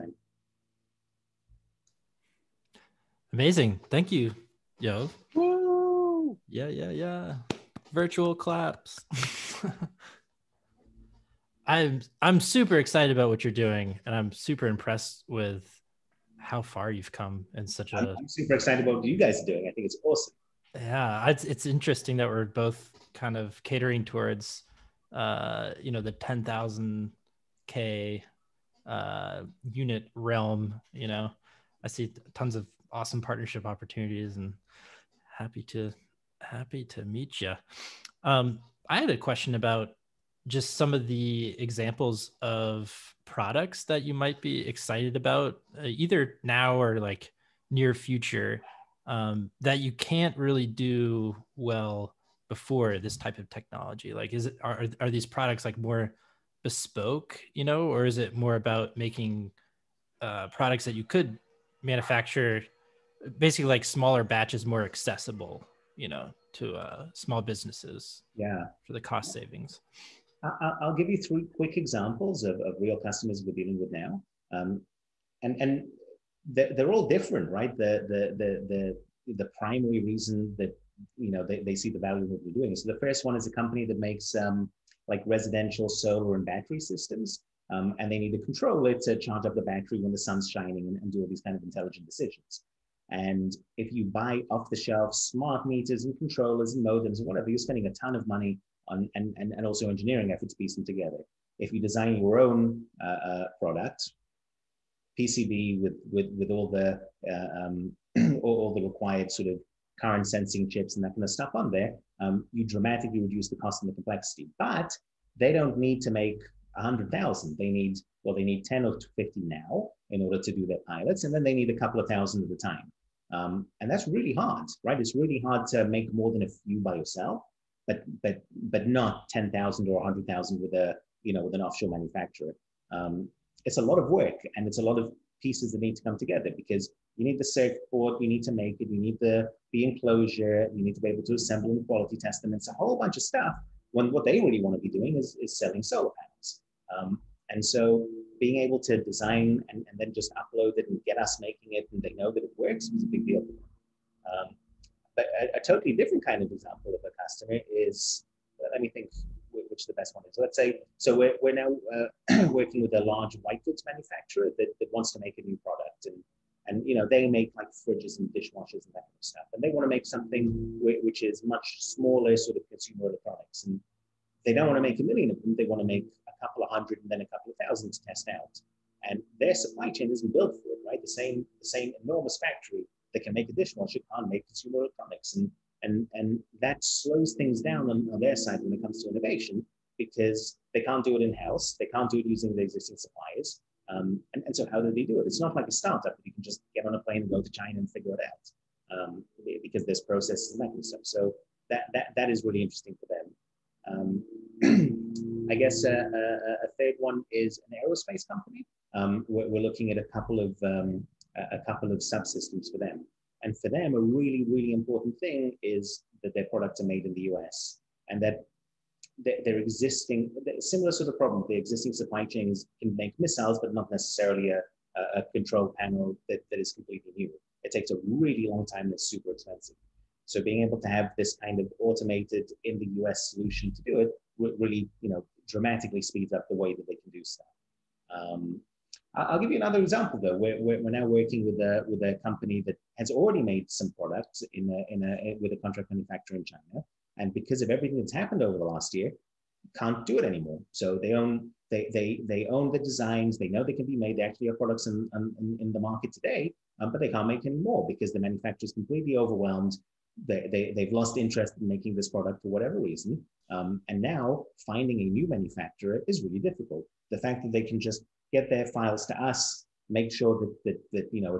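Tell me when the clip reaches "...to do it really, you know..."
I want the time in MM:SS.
03:53.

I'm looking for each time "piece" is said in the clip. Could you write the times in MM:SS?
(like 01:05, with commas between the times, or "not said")
01:40, 02:15.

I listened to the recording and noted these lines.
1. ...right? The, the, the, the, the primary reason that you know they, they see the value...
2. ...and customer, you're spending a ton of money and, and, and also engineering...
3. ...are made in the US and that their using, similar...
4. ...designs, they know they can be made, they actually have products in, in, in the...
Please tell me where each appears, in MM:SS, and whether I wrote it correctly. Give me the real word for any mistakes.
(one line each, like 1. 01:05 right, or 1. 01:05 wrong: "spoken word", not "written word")
1. 01:17 right
2. 01:37 wrong: "whatever", not "customer"
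3. 03:36 wrong: "existing", not "using"
4. 04:12 right.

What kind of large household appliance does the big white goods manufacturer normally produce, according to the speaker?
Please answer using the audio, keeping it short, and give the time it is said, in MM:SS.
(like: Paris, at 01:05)
Fridges, at 02:47.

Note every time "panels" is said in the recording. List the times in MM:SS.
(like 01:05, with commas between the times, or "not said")
02:26, 03:45.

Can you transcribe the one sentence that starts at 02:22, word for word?
It's a whole bunch of stuff.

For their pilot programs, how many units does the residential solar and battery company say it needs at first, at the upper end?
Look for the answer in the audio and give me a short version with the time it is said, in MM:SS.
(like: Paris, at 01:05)
50, at 01:59.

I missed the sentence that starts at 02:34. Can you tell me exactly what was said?
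Um, but a, a, totally different kind of example of a customer is let me think which the best one is.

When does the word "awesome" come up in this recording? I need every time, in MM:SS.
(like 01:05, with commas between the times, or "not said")
00:20, 00:32.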